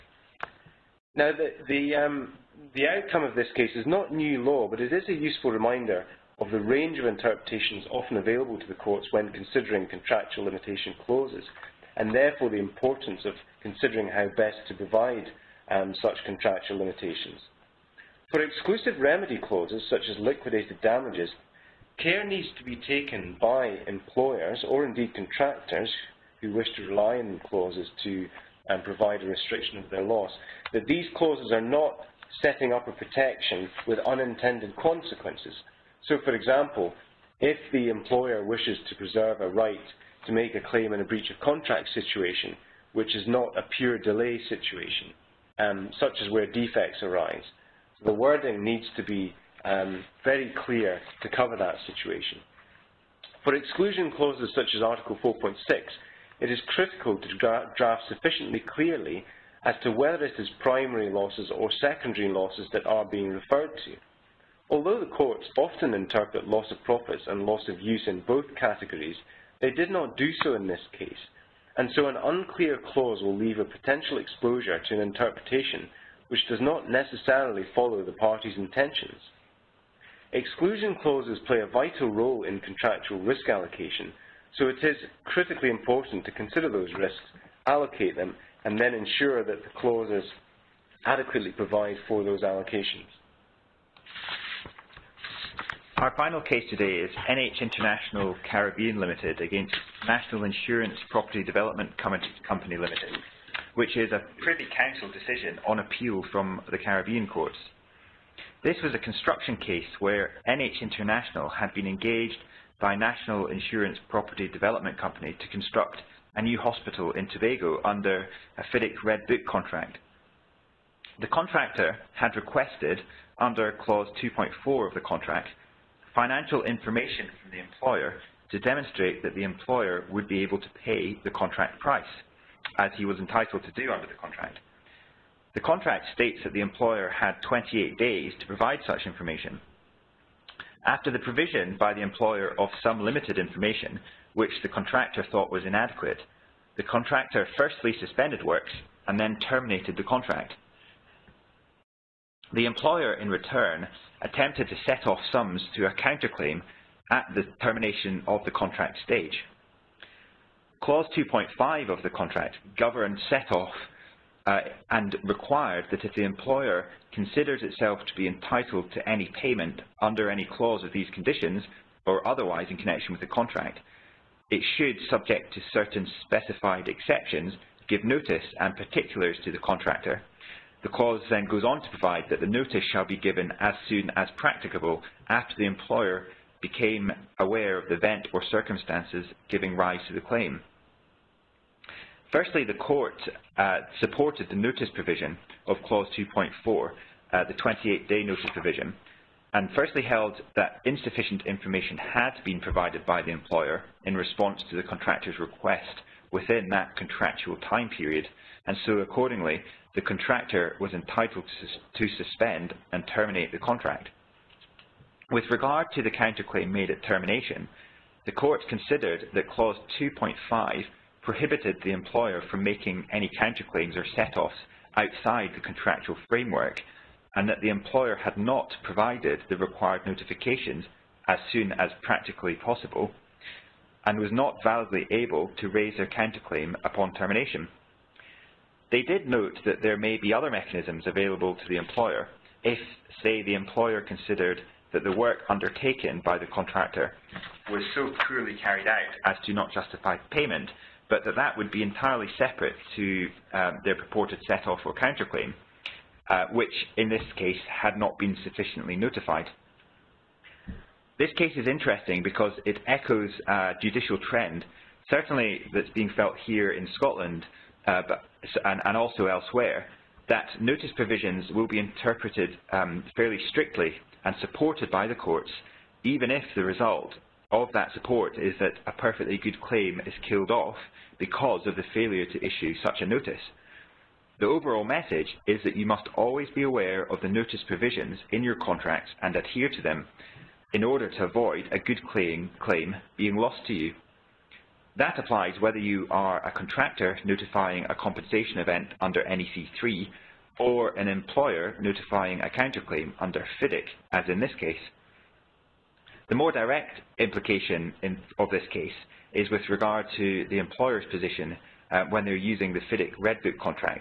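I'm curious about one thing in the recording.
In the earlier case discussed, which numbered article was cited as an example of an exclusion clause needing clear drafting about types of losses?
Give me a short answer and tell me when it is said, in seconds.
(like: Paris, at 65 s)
Article 4.6, at 54 s.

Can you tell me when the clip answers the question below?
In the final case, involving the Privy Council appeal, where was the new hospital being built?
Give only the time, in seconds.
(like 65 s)
117 s.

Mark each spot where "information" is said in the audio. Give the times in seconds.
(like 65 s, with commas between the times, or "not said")
126 s, 139 s, 143 s, 201 s.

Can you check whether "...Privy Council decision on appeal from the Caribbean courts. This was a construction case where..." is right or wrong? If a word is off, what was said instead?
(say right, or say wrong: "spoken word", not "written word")
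right.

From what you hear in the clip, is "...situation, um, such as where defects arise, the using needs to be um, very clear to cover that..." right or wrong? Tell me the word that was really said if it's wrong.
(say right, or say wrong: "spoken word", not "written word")
wrong: "wording", not "using".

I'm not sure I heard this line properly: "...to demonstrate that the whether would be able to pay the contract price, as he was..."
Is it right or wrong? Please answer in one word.
wrong.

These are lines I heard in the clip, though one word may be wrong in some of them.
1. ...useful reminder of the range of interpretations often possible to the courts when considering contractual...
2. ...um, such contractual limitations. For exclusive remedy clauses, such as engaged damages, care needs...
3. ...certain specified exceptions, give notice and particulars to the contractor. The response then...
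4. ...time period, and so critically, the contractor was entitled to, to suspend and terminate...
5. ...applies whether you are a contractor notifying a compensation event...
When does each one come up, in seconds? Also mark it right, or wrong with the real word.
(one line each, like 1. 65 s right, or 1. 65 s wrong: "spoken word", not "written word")
1. 5 s wrong: "available", not "possible"
2. 15 s wrong: "liquidated", not "engaged"
3. 175 s wrong: "clause", not "response"
4. 207 s wrong: "accordingly", not "critically"
5. 295 s right.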